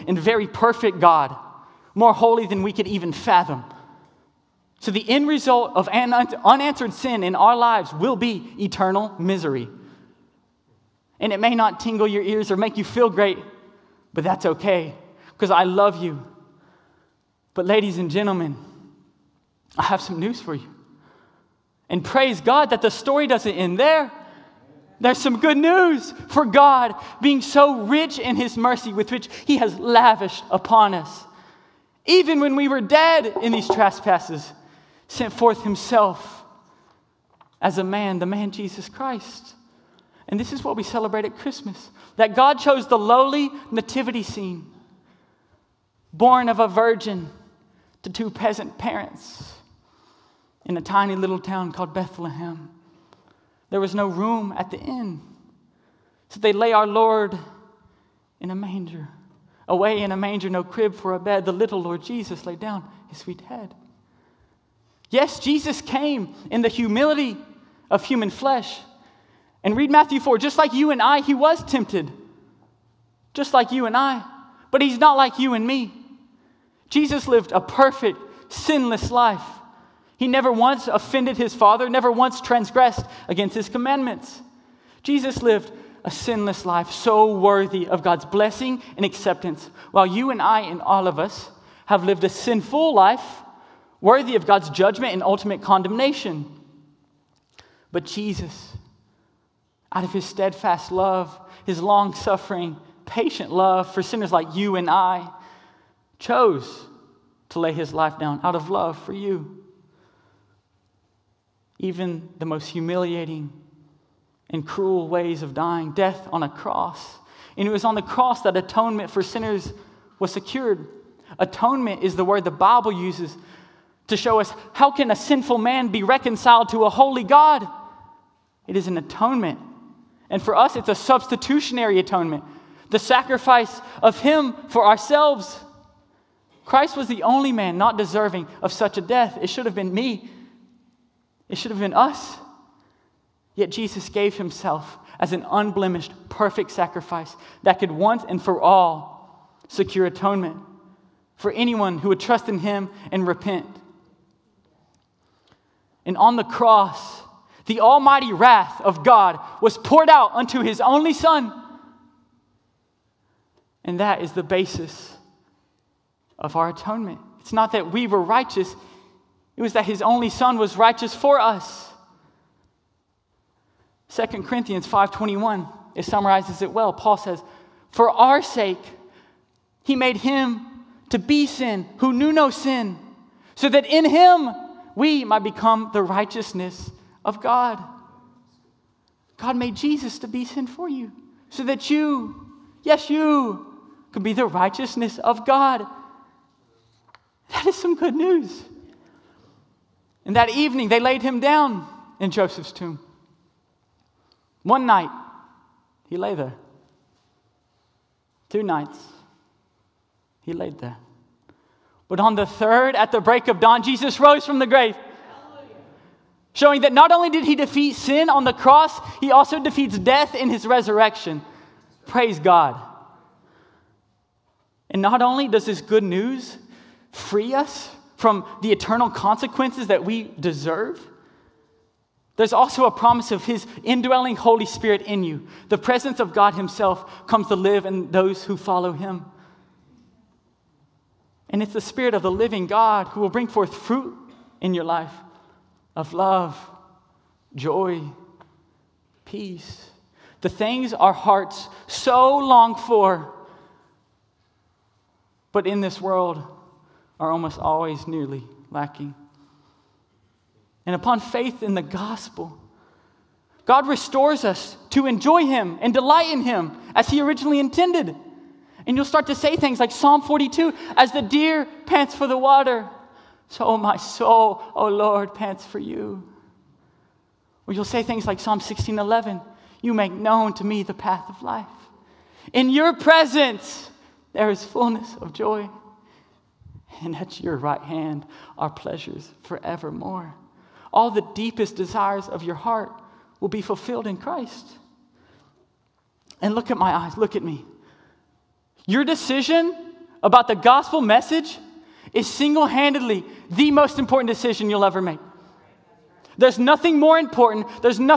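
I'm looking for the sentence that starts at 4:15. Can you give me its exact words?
But in this world, are almost always nearly lacking.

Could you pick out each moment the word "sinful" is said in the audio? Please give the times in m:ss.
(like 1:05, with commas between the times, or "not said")
1:32, 2:05.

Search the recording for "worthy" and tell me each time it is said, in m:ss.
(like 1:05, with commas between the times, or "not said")
1:27, 1:34.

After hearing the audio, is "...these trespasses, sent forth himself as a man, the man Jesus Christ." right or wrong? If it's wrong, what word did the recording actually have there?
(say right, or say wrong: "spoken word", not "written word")
right.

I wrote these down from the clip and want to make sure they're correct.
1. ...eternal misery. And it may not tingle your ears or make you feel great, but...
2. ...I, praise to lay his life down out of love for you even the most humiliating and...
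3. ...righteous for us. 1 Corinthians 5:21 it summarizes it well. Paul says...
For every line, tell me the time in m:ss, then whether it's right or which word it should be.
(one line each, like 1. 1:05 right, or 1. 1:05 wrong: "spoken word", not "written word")
1. 0:08 right
2. 1:44 wrong: "chose", not "praise"
3. 2:50 wrong: "2", not "1".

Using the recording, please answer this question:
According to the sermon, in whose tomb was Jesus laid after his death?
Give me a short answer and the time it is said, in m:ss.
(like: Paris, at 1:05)
Joseph's tomb, at 3:22.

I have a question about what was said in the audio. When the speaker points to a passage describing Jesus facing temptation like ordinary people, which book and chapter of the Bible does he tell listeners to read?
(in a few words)
Matthew 4.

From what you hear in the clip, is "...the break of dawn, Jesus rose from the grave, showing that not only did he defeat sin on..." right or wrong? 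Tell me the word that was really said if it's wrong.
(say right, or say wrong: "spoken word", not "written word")
right.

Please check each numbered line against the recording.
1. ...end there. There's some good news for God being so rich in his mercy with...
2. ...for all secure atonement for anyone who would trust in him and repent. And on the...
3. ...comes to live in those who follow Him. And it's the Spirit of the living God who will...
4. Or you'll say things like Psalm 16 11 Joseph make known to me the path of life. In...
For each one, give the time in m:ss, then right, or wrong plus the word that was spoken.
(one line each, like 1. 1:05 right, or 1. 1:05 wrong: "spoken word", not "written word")
1. 0:23 right
2. 2:28 right
3. 3:57 right
4. 4:37 wrong: "You", not "Joseph".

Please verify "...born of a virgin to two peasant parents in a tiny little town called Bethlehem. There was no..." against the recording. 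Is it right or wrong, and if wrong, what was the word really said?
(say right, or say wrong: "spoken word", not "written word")
right.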